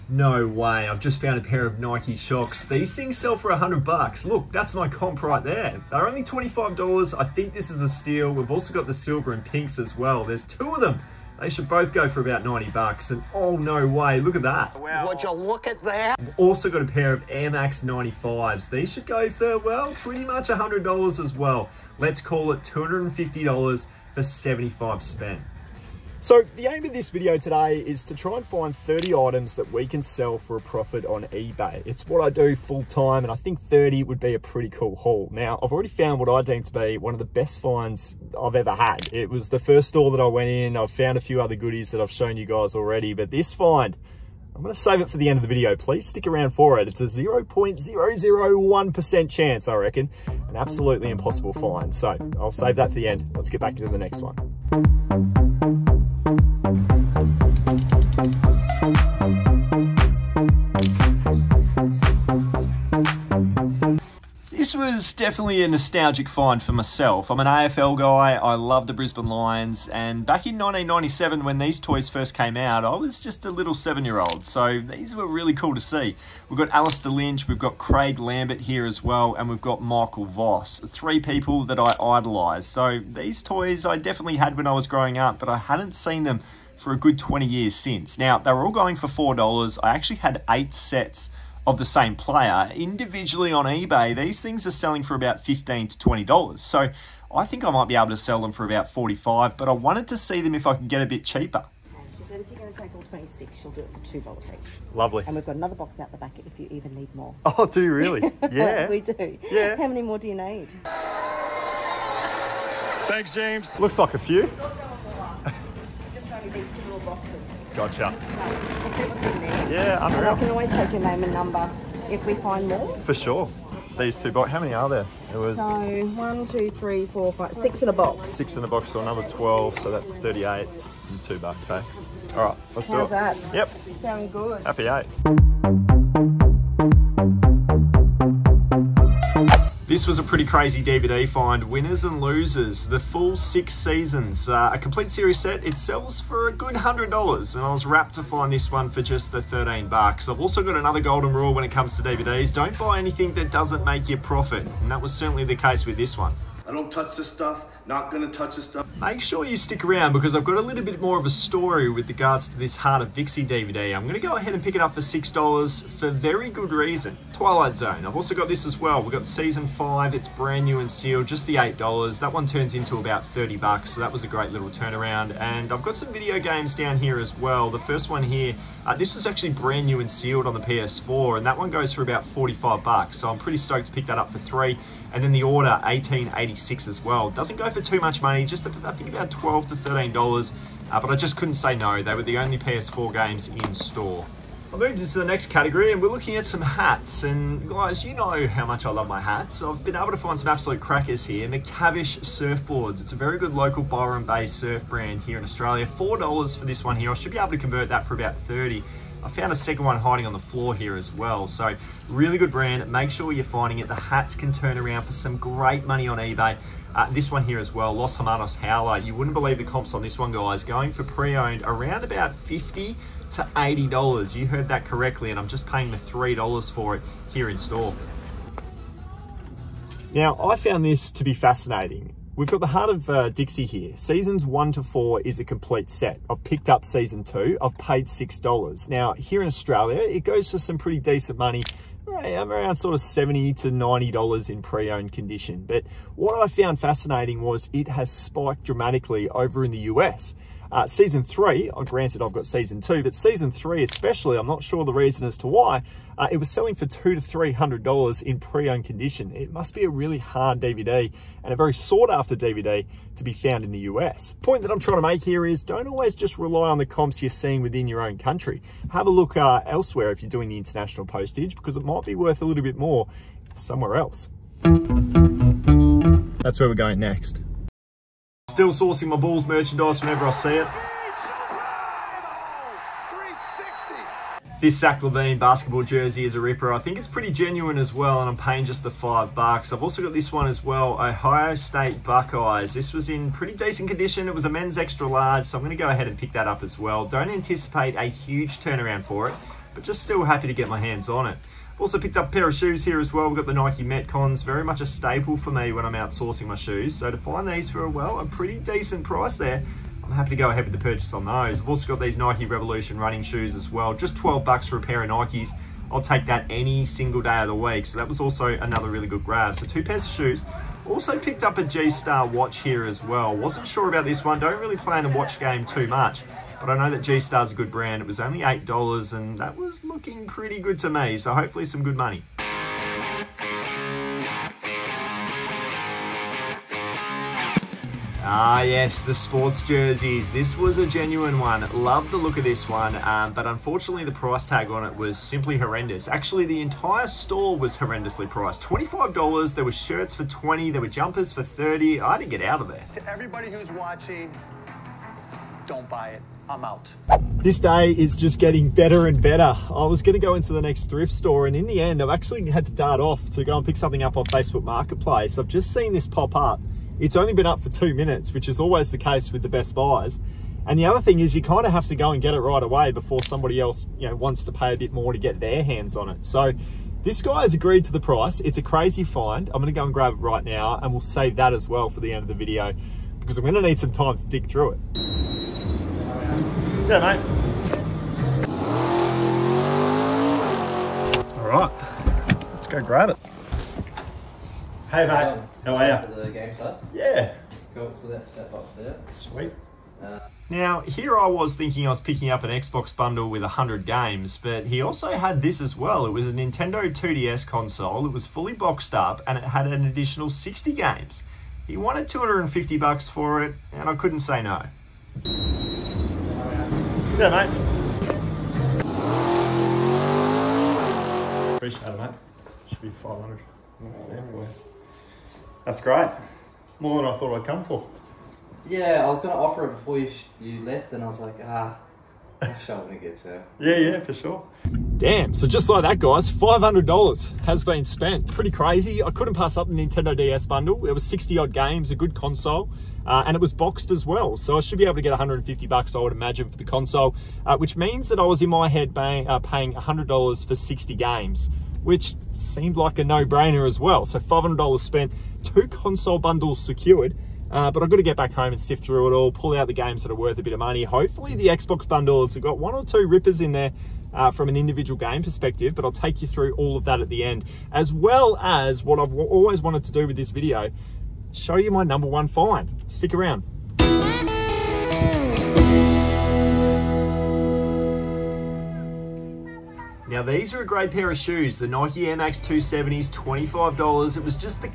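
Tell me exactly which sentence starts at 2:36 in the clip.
I don't touch this stuff, not gonna touch this stuff.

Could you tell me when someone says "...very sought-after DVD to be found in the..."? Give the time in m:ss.
4:21.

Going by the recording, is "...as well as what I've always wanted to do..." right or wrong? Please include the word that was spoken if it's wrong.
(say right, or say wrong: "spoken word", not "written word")
right.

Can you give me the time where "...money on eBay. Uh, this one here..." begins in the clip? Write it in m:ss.
3:35.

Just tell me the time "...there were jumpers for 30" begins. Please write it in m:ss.
5:50.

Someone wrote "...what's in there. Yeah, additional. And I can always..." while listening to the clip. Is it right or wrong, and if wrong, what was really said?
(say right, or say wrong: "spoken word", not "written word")
wrong: "unreal", not "additional".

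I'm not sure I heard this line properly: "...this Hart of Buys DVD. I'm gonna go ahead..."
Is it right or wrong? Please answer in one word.
wrong.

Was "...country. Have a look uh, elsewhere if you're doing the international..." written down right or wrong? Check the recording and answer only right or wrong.
right.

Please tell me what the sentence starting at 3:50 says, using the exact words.
Now, I found this to be fascinating.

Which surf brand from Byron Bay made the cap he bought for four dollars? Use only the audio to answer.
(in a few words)
McTavish Surfboards.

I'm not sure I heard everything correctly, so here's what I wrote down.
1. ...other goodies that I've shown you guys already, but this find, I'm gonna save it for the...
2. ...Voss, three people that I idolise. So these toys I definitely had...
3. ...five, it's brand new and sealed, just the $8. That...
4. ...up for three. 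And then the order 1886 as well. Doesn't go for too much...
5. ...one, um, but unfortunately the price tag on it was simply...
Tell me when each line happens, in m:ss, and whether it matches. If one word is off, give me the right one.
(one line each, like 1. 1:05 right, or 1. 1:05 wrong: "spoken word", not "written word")
1. 0:41 right
2. 1:20 right
3. 2:49 right
4. 3:04 right
5. 5:42 right.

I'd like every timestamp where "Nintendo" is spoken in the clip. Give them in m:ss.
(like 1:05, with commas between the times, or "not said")
6:46, 7:19.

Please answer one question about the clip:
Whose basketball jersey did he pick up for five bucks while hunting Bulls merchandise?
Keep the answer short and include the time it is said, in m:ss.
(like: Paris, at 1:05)
Zach LaVine, at 4:44.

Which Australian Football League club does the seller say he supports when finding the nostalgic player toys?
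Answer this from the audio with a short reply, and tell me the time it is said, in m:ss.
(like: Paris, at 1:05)
Brisbane Lions, at 1:08.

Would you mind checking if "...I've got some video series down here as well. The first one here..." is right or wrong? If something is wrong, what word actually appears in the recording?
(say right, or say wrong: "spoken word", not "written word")
wrong: "games", not "series".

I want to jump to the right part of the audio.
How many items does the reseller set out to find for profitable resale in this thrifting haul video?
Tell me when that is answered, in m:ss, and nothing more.
0:28.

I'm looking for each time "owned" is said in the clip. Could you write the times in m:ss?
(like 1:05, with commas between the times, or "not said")
3:41, 4:04, 4:18.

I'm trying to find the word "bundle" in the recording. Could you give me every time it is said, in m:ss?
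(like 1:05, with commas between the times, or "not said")
6:42, 7:20, 7:36, 7:41.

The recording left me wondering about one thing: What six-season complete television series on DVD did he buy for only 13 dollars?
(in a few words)
Winners and Losers.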